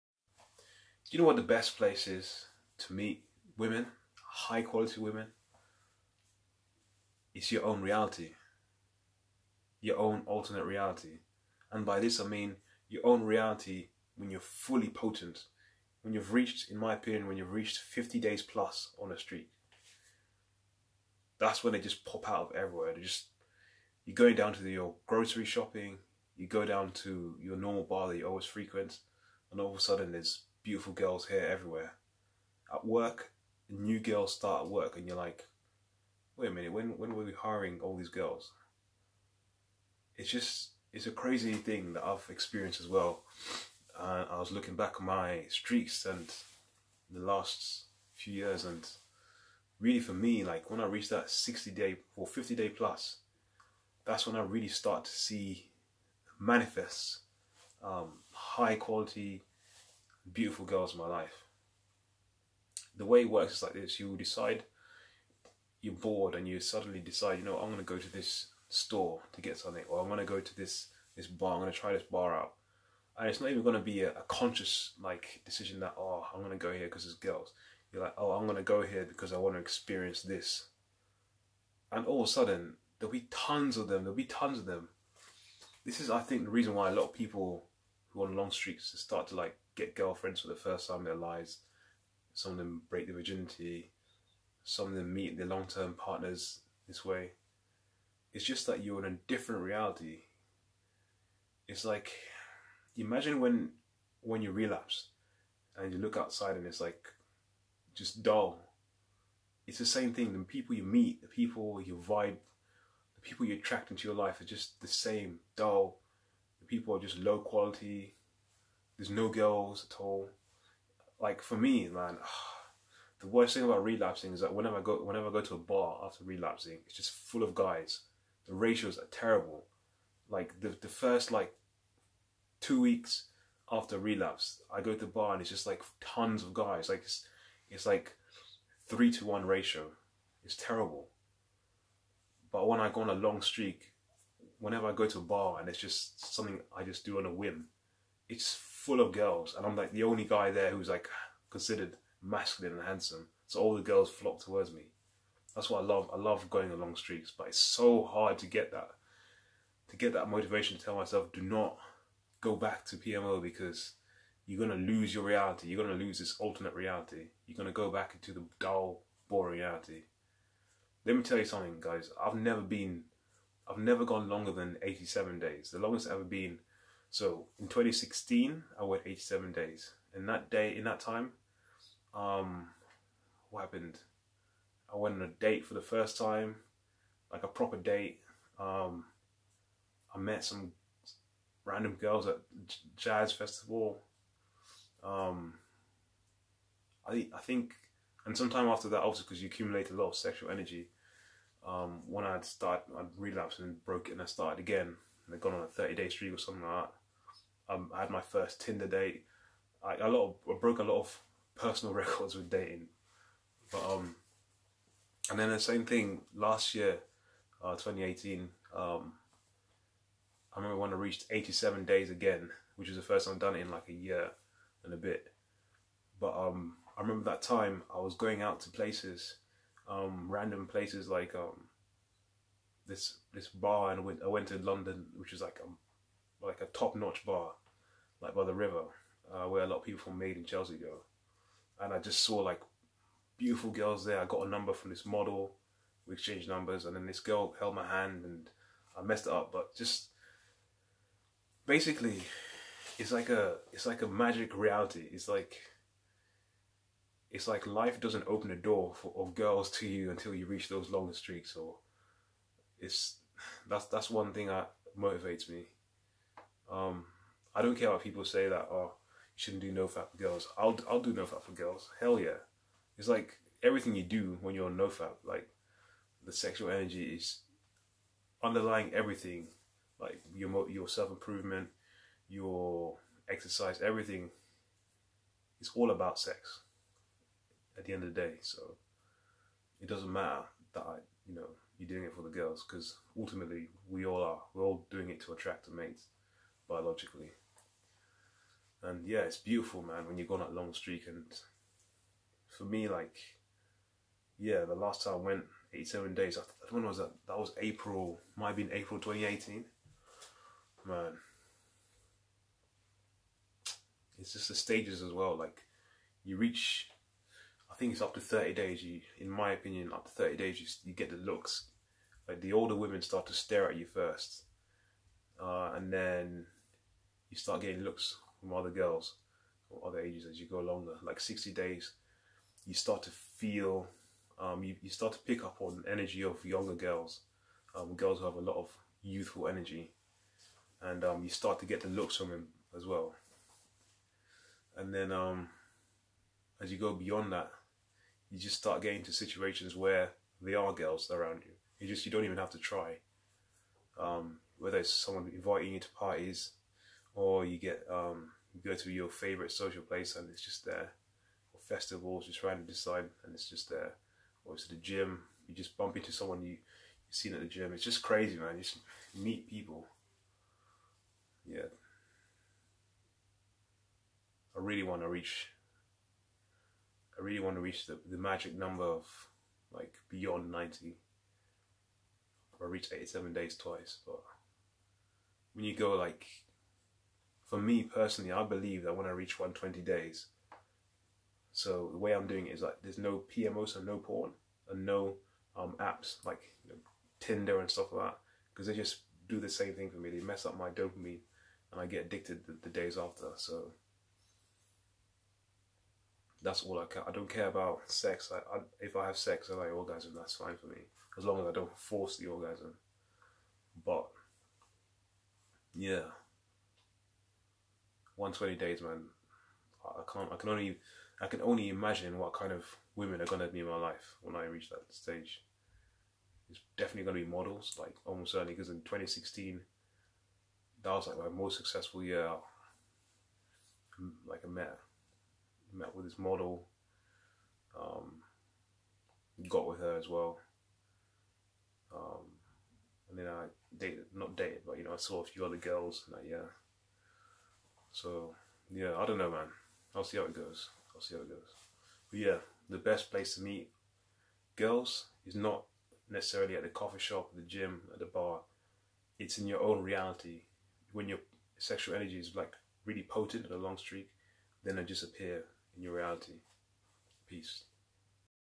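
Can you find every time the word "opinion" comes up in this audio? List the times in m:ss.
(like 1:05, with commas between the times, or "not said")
0:16, 5:19.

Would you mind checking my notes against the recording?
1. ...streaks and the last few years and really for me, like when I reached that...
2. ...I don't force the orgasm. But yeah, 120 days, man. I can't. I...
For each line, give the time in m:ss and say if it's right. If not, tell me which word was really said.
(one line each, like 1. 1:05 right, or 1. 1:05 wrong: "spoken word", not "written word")
1. 0:45 right
2. 6:51 right.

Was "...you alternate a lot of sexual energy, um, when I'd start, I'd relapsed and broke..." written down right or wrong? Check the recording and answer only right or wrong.
wrong.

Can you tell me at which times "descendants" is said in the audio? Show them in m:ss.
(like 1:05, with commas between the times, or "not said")
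not said.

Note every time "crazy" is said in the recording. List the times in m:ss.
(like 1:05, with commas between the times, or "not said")
0:41, 6:08.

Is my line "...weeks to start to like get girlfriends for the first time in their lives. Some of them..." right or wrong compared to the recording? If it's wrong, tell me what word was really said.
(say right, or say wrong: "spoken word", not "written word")
wrong: "streaks", not "weeks".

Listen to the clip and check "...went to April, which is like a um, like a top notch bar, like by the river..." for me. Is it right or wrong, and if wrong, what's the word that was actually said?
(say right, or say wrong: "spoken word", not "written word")
wrong: "London", not "April".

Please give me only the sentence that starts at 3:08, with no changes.
Um, I met some random girls at jazz festival.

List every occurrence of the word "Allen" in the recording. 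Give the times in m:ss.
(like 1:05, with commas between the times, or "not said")
not said.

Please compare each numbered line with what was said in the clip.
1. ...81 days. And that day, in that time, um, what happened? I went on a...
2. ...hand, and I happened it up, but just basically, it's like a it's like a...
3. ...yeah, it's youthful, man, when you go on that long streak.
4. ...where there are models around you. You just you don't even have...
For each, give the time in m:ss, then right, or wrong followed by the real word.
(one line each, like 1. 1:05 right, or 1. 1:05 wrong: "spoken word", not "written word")
1. 2:59 wrong: "87", not "81"
2. 4:07 wrong: "messed", not "happened"
3. 4:59 wrong: "beautiful", not "youthful"
4. 5:49 wrong: "girls", not "models".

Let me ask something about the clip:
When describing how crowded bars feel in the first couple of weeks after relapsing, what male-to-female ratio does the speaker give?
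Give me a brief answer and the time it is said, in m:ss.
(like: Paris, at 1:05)
3 to 1, at 2:18.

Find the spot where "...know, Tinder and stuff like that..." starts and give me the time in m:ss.
6:36.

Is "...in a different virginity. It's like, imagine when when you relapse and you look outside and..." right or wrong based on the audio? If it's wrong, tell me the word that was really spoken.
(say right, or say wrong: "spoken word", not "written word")
wrong: "reality", not "virginity".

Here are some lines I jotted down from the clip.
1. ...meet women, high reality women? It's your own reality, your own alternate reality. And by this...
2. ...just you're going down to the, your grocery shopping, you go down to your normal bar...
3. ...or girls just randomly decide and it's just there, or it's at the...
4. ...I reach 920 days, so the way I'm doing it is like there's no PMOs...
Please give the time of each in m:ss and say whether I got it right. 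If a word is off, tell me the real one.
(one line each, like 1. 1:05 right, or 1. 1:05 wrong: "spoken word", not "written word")
1. 0:02 wrong: "quality", not "reality"
2. 0:23 right
3. 6:01 wrong: "festivals", not "girls"
4. 6:29 wrong: "120", not "920".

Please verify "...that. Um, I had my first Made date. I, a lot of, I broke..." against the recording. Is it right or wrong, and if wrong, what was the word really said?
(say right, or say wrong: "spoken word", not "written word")
wrong: "Tinder", not "Made".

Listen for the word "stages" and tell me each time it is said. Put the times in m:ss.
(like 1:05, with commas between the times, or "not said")
5:14, 7:04.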